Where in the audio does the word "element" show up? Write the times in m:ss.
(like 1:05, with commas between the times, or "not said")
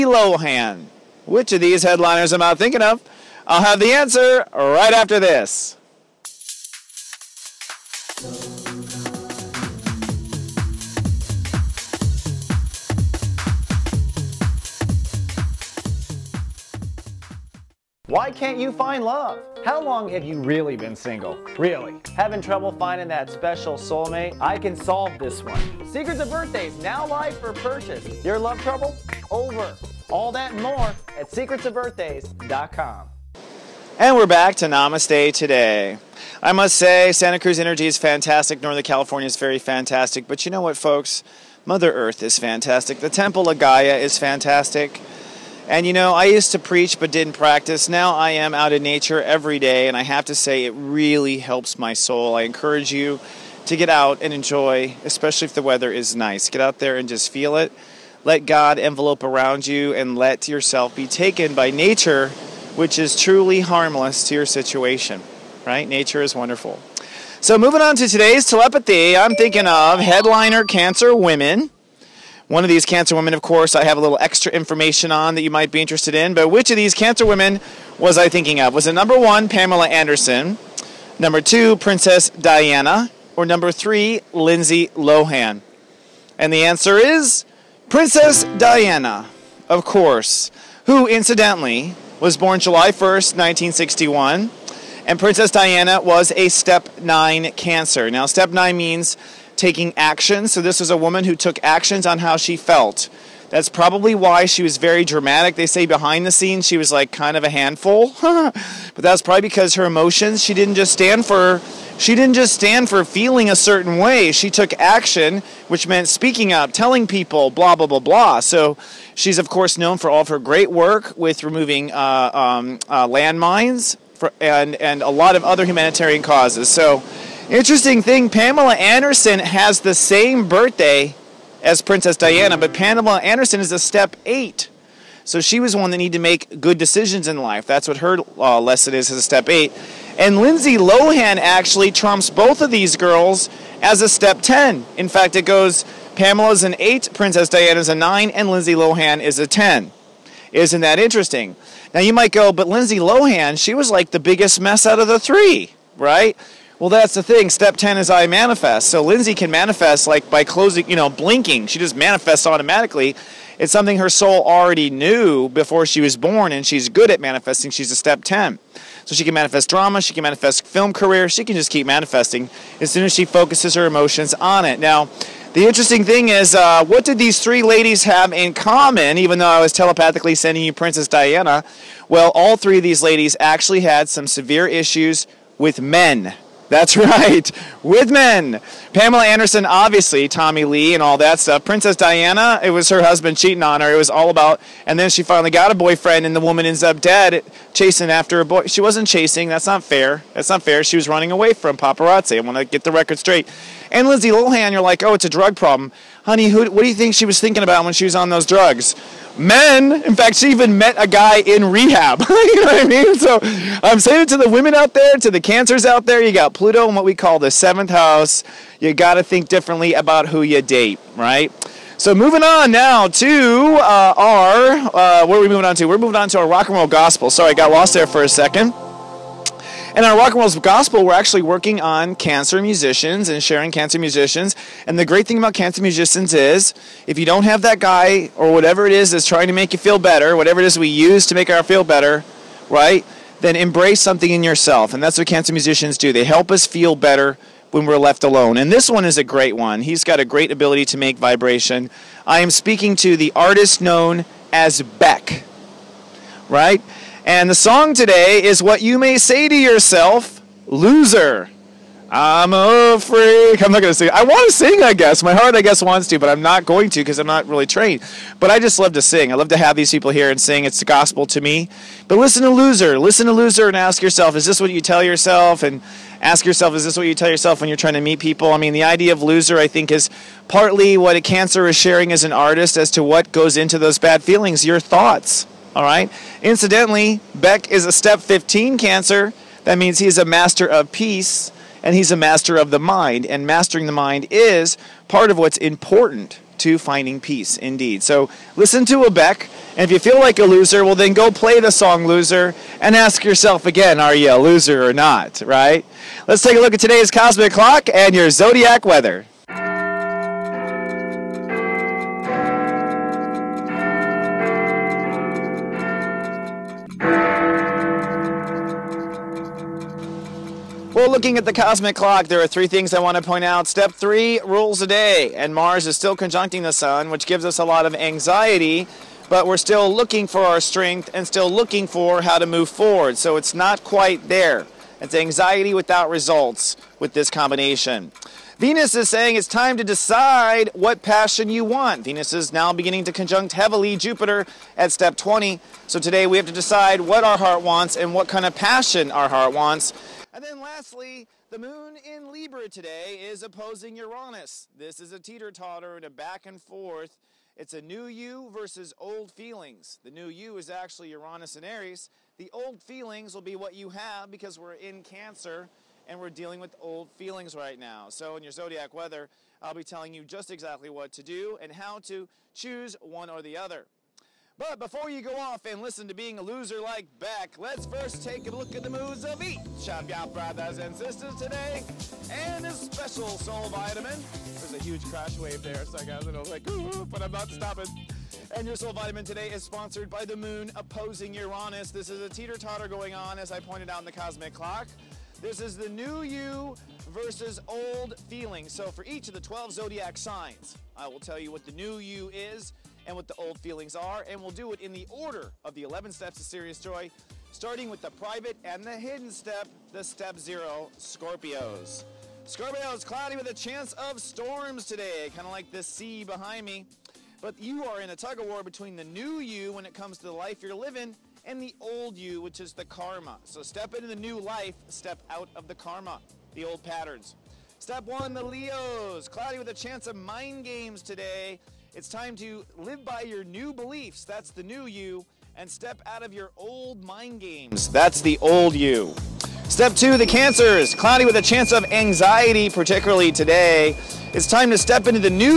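not said.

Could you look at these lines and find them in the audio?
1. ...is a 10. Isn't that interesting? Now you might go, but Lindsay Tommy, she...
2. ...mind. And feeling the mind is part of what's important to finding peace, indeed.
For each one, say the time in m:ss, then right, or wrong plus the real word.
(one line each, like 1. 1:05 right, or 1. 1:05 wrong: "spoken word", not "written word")
1. 2:29 wrong: "Lohan", not "Tommy"
2. 4:52 wrong: "mastering", not "feeling".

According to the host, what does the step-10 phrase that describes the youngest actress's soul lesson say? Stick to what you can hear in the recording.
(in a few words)
I manifest.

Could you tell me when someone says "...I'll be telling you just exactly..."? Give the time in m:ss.
6:09.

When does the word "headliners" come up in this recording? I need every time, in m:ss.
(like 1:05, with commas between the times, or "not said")
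0:01, 1:09.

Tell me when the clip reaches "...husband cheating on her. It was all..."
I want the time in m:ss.
3:13.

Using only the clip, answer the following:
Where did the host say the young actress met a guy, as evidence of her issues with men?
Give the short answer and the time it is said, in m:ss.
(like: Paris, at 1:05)
rehab, at 3:31.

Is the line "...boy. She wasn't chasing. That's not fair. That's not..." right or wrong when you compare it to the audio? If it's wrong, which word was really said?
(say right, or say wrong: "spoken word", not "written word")
right.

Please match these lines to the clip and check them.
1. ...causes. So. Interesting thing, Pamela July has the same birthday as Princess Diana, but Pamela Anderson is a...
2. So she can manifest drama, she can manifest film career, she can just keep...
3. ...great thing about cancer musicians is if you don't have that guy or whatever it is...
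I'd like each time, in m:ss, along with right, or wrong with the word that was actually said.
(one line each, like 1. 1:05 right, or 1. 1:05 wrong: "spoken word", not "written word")
1. 2:06 wrong: "Anderson", not "July"
2. 2:49 right
3. 3:55 right.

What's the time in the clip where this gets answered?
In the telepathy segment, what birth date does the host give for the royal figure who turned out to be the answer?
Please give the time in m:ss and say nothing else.
1:32.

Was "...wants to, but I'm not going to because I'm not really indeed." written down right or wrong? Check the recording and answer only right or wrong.
wrong.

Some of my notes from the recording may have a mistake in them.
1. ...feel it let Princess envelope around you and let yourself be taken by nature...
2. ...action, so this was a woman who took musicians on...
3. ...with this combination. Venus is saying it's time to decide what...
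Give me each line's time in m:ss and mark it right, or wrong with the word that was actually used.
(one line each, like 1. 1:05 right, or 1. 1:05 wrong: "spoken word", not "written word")
1. 0:57 wrong: "God", not "Princess"
2. 1:39 wrong: "actions", not "musicians"
3. 5:36 right.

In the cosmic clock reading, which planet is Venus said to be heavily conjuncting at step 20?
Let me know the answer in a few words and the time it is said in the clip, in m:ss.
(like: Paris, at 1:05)
Jupiter, at 5:43.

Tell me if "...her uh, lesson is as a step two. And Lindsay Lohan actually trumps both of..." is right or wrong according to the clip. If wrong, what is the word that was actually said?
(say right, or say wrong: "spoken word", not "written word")
wrong: "eight", not "two".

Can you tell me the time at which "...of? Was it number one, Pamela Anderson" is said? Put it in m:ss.
1:18.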